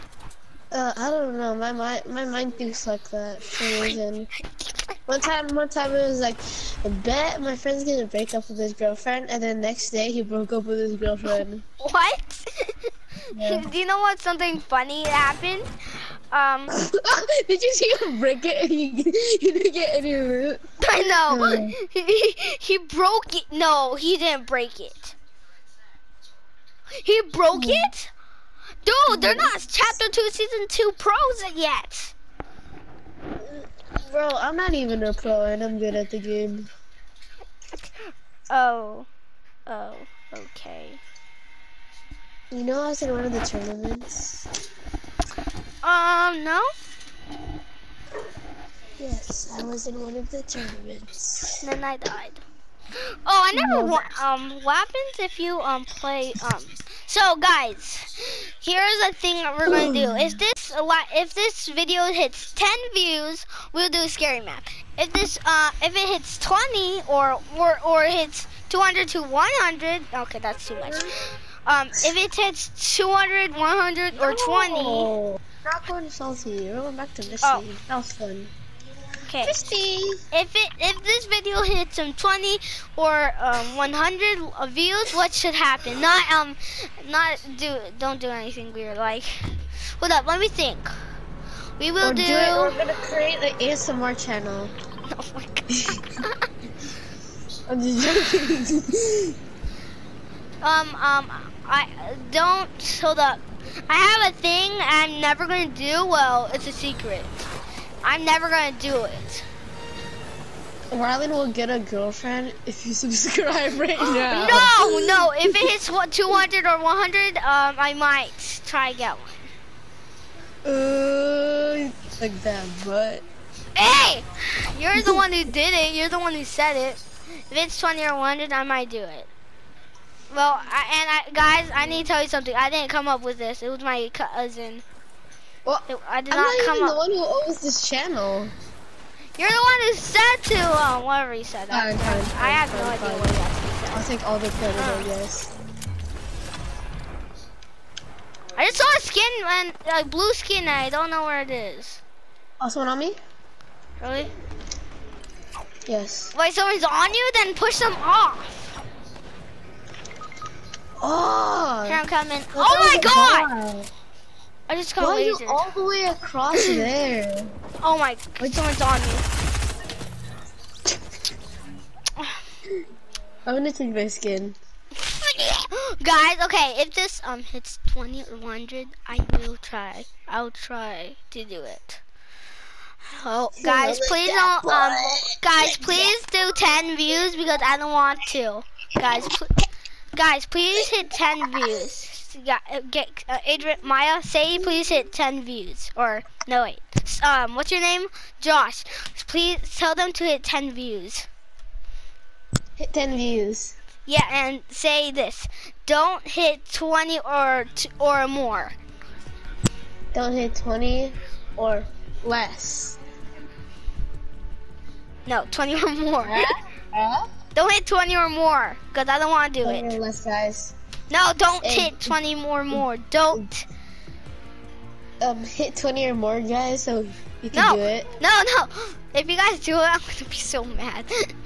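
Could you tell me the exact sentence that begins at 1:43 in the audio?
I have a thing I'm never gonna do.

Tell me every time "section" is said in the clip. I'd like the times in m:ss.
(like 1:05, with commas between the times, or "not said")
not said.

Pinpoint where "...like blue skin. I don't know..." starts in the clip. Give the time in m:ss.
2:29.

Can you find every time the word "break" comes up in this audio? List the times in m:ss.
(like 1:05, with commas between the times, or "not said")
0:08, 0:18, 0:24.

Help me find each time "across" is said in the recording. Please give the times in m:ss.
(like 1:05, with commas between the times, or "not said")
2:46.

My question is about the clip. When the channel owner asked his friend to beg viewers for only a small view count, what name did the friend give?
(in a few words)
Josh.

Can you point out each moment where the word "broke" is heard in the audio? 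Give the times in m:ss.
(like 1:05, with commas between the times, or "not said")
0:10, 0:22, 0:27.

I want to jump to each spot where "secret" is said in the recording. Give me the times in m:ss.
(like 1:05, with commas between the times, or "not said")
1:46.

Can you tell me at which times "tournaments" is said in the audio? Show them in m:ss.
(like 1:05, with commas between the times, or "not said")
0:43, 0:50.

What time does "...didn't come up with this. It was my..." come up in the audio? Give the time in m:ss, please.
2:12.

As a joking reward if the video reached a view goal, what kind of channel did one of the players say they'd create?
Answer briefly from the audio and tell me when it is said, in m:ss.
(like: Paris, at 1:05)
An ASMR channel, at 1:33.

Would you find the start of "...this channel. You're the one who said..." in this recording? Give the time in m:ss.
2:17.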